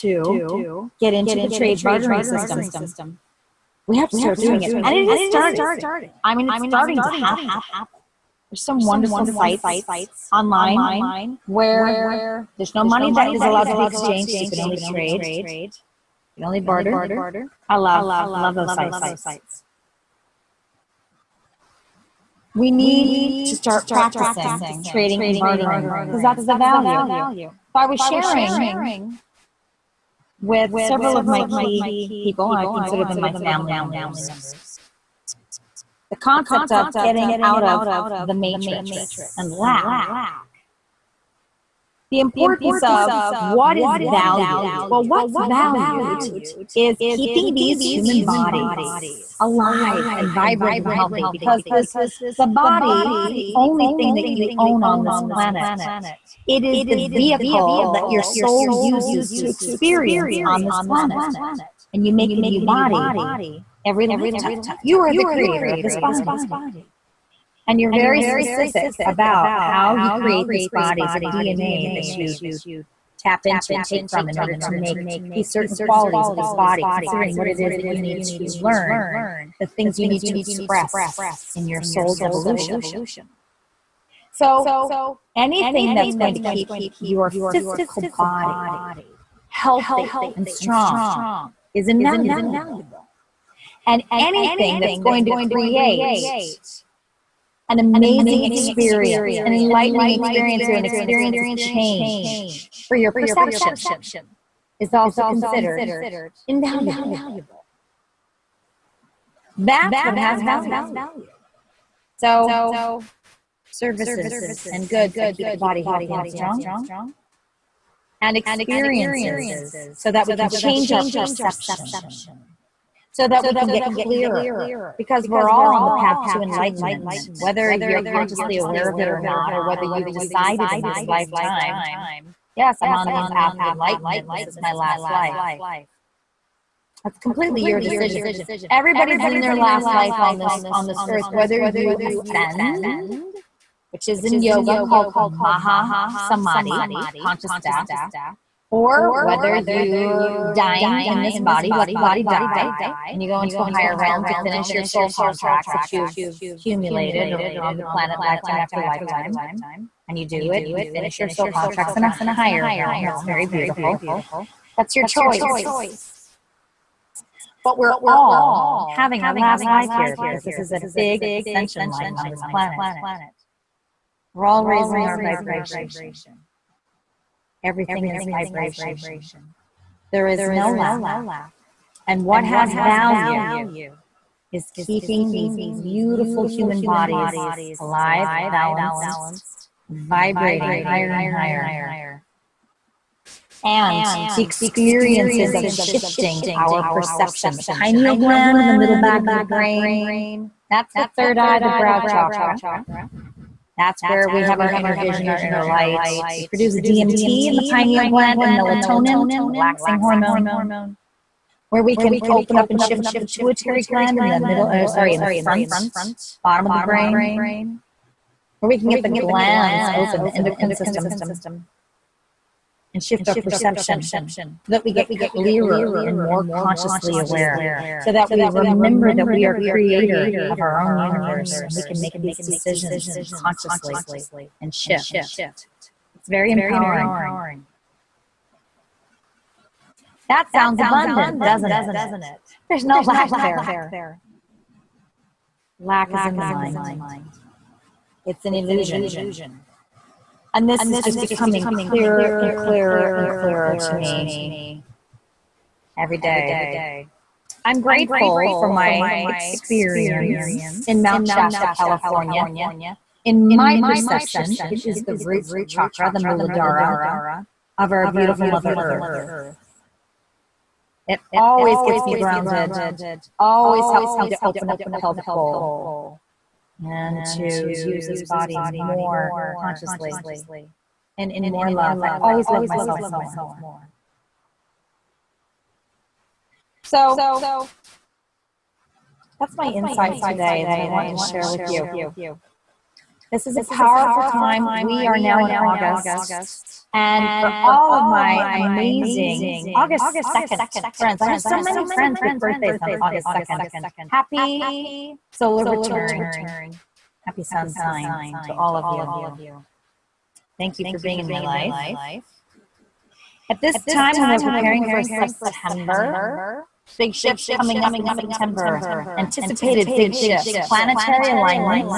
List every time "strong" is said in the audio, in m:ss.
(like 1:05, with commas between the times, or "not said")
1:30, 1:56.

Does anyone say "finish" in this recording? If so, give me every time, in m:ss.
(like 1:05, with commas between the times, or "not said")
2:34, 2:40.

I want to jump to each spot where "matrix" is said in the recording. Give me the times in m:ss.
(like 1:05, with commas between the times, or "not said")
0:38.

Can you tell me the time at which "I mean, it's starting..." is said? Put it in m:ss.
0:06.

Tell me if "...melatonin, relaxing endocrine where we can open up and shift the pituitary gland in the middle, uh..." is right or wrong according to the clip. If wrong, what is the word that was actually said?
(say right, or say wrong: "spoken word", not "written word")
wrong: "hormone", not "endocrine".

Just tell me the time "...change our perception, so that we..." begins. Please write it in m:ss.
2:00.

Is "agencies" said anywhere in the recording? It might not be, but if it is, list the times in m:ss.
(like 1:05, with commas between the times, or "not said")
not said.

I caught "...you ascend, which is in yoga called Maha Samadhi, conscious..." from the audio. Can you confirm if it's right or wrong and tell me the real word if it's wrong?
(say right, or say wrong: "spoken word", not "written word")
right.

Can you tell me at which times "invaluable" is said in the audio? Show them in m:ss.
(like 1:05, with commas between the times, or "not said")
1:31, 1:46.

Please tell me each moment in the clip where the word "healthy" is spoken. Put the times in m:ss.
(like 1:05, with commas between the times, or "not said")
0:50, 1:29, 1:55.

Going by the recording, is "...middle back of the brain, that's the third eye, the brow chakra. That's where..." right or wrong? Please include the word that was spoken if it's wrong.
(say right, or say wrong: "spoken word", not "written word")
right.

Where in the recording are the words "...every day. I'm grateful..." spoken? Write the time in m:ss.
4:15.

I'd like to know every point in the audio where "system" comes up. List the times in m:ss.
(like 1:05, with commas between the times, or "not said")
0:02, 3:40.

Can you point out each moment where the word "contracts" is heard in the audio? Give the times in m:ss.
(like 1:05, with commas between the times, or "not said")
2:35, 2:41.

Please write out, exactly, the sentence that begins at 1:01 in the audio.
And you make a new body every lifetime.